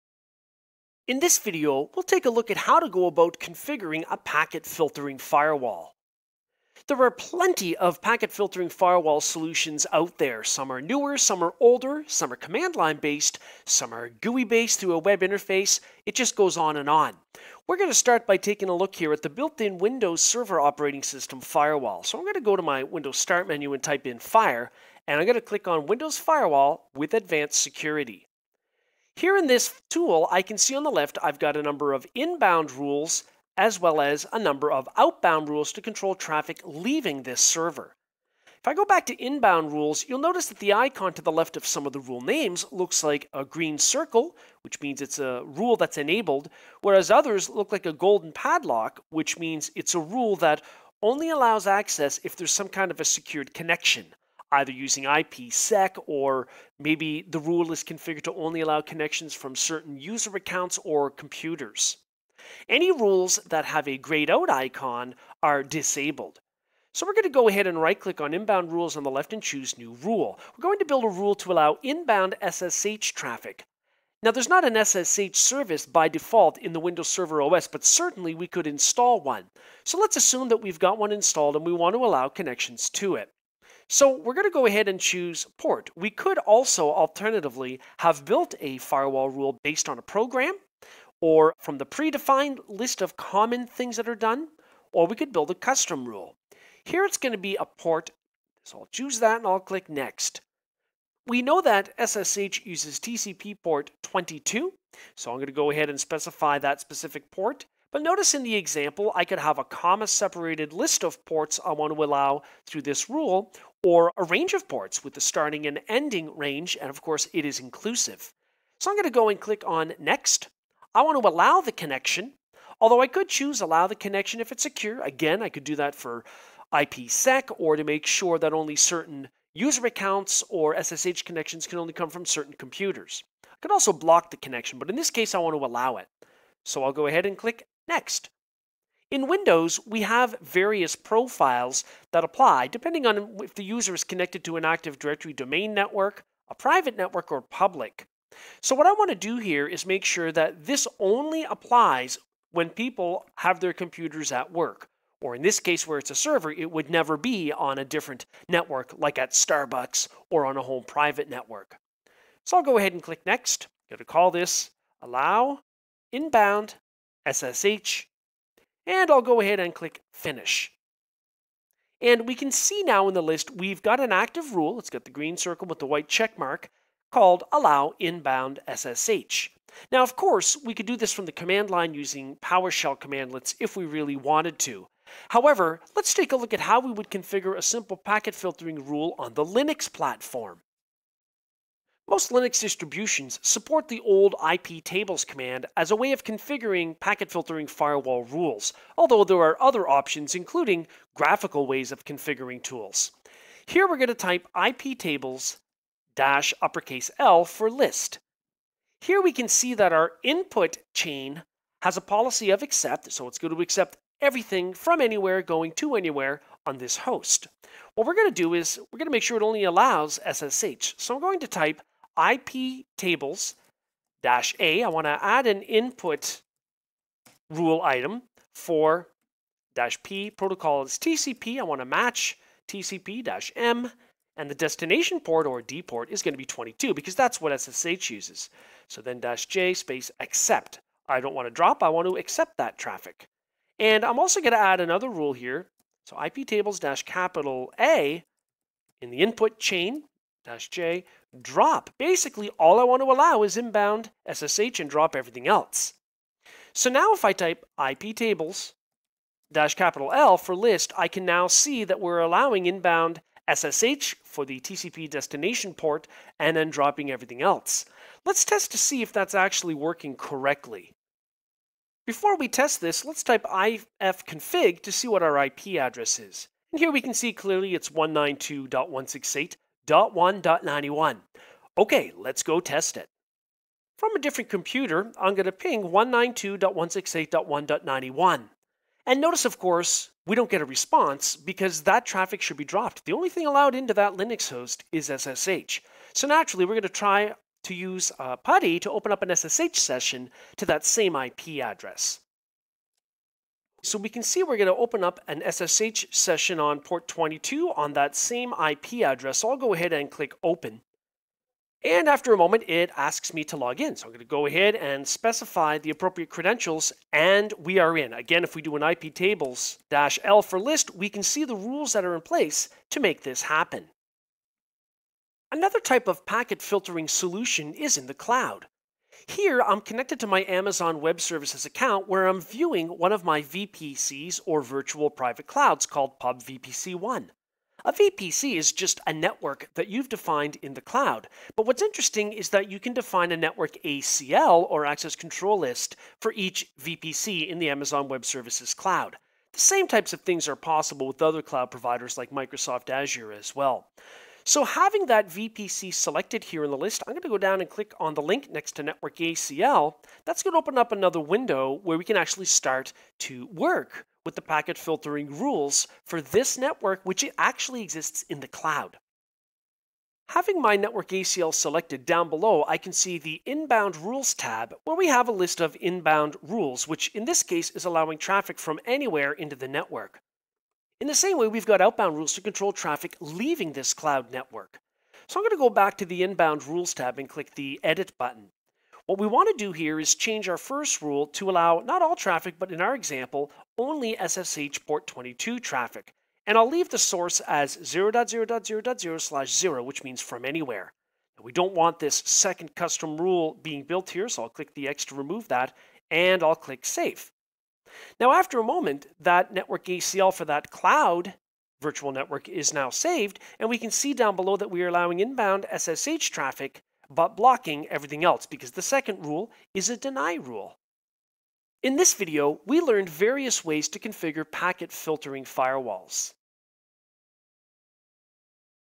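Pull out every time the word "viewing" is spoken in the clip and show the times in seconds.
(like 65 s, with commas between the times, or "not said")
332 s.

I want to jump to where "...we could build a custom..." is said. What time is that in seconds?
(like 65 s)
95 s.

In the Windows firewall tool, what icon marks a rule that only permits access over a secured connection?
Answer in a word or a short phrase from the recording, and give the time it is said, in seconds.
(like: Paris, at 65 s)
Golden padlock, at 47 s.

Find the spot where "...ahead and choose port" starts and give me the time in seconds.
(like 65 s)
84 s.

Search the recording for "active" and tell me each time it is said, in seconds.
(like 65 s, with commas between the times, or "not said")
144 s, 174 s.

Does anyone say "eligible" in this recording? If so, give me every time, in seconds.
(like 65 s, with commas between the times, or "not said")
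not said.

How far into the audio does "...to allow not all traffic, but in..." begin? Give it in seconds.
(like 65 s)
391 s.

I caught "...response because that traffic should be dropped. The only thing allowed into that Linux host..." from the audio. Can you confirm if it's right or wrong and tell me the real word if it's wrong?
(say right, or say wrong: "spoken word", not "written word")
right.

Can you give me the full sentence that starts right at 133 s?
I could also block the connection, but in this case I want to allow it.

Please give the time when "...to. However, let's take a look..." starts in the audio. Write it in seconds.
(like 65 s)
184 s.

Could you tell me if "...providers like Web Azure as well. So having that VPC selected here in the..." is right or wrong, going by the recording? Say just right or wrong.
wrong.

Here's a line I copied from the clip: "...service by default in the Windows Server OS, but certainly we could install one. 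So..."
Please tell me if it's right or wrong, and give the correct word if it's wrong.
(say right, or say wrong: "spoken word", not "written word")
right.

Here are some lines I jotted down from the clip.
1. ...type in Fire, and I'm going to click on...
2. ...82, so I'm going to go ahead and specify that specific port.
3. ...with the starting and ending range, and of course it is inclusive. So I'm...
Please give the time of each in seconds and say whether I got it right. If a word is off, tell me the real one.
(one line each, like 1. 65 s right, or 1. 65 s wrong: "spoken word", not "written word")
1. 23 s right
2. 104 s wrong: "22", not "82"
3. 115 s right.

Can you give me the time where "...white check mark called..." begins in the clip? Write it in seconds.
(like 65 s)
175 s.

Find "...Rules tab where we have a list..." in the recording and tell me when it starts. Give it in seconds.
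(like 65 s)
373 s.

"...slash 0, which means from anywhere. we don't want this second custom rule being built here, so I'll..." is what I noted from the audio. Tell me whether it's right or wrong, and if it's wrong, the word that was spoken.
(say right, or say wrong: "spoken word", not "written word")
right.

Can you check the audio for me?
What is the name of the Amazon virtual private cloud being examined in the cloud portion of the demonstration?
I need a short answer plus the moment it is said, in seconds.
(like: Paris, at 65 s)
PubVPC1, at 336 s.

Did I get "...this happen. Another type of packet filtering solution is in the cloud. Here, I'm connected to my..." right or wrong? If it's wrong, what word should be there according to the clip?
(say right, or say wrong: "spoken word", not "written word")
right.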